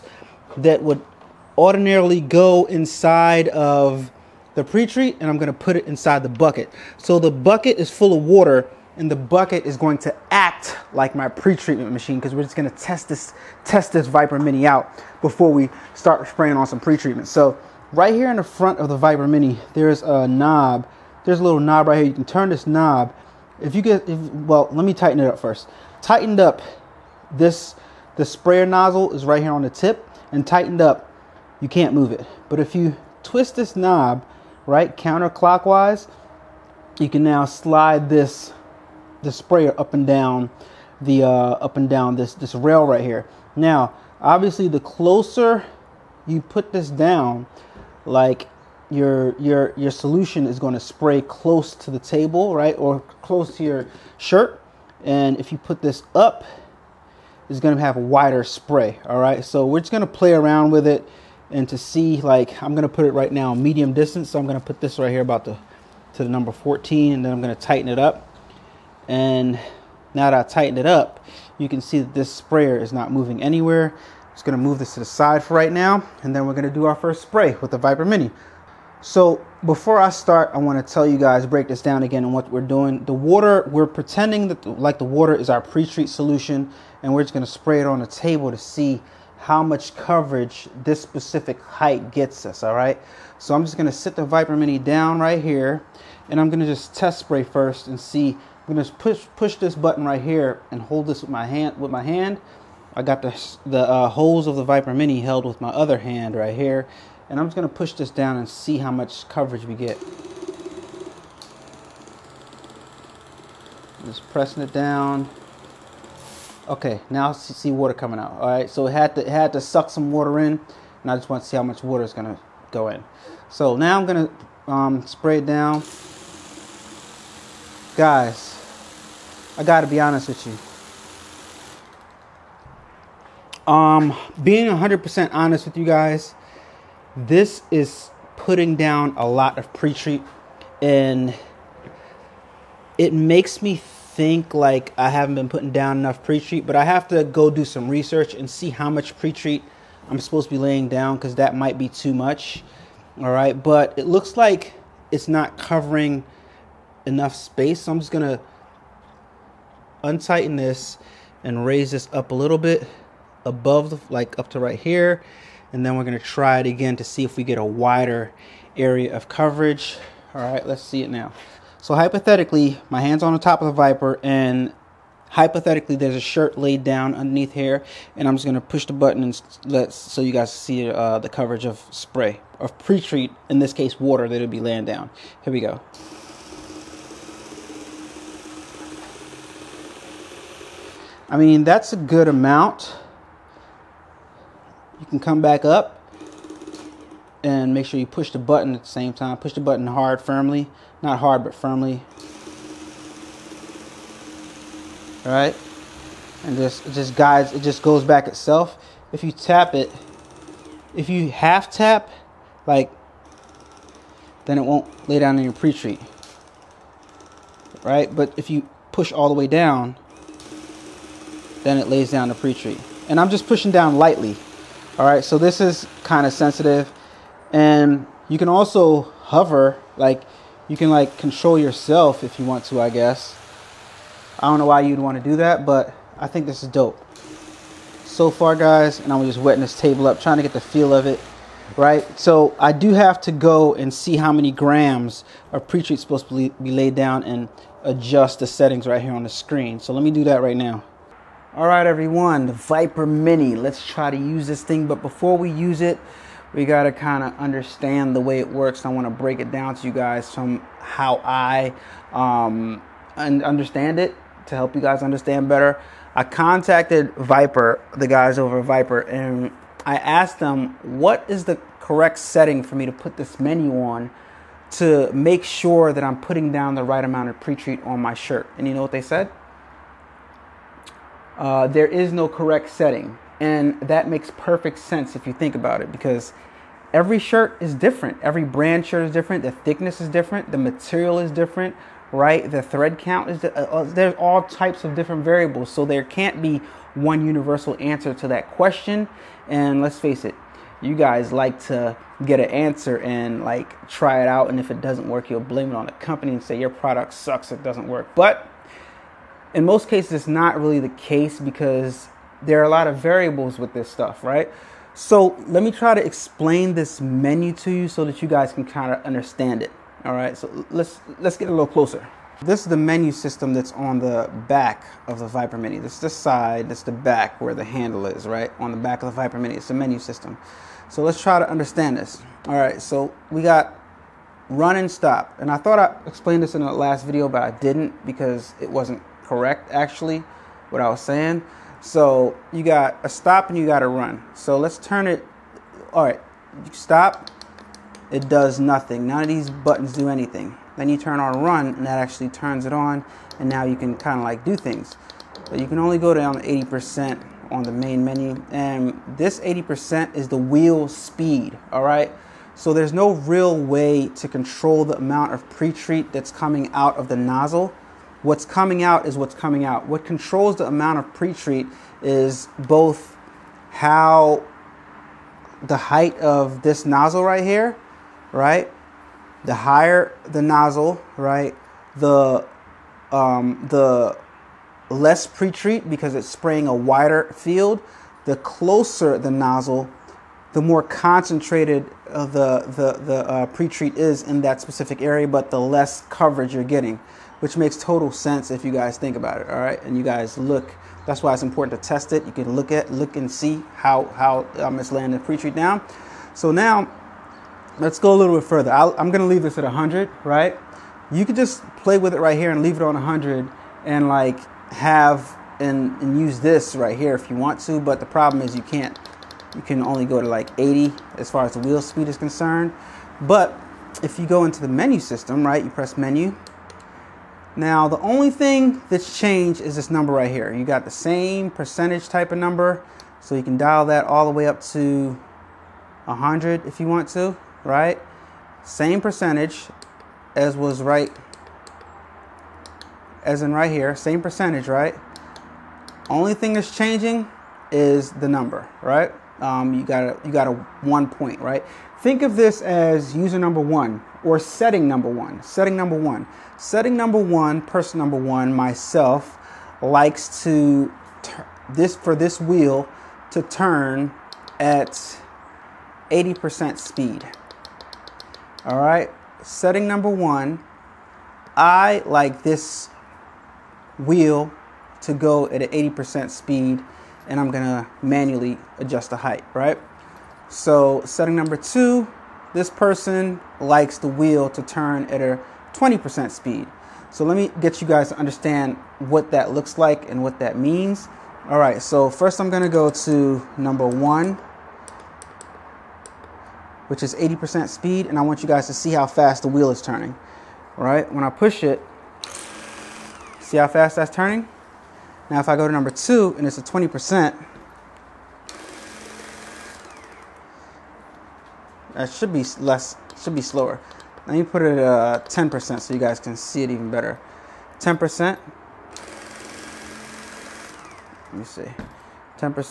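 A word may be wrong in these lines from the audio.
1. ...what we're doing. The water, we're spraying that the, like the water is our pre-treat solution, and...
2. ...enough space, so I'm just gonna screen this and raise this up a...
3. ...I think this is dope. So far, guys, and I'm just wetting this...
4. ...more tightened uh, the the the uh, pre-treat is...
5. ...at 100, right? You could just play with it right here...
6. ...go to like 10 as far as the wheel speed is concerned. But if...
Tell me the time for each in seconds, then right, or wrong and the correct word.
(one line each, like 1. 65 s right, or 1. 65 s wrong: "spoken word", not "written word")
1. 82 s wrong: "pretending", not "spraying"
2. 157 s wrong: "untighten", not "screen"
3. 236 s right
4. 390 s wrong: "concentrated", not "tightened"
5. 409 s right
6. 420 s wrong: "80", not "10".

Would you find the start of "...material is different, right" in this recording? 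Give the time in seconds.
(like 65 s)
290 s.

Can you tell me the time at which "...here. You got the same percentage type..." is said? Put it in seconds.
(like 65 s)
430 s.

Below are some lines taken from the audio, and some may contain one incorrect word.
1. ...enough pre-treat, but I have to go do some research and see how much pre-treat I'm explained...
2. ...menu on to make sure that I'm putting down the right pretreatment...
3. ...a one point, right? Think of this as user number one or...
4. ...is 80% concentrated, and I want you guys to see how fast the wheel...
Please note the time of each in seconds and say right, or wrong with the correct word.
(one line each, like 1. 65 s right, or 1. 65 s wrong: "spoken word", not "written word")
1. 145 s wrong: "supposed", not "explained"
2. 273 s wrong: "amount", not "pretreatment"
3. 450 s right
4. 497 s wrong: "speed", not "concentrated".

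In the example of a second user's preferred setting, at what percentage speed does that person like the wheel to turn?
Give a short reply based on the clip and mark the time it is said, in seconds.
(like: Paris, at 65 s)
20%, at 485 s.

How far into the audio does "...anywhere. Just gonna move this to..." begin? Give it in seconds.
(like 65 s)
73 s.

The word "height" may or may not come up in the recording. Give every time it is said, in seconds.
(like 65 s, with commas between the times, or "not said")
91 s, 375 s, 479 s.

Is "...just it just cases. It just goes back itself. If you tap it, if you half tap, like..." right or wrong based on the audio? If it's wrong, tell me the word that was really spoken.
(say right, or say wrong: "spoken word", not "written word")
wrong: "guides", not "cases".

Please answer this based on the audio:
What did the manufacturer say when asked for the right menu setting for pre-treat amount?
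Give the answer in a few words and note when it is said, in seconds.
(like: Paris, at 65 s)
no correct setting, at 281 s.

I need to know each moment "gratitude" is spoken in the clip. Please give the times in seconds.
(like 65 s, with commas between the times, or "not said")
not said.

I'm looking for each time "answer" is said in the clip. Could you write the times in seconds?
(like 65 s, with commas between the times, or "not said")
297 s, 302 s.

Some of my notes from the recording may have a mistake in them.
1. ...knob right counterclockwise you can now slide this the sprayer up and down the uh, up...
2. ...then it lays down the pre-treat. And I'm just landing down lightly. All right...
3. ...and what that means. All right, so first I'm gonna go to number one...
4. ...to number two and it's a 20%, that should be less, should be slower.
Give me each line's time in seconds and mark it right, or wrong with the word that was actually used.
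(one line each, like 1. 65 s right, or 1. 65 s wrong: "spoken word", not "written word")
1. 33 s right
2. 221 s wrong: "pushing", not "landing"
3. 490 s right
4. 505 s right.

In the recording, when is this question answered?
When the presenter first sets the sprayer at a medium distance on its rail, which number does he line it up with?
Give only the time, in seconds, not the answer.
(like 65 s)
66 s.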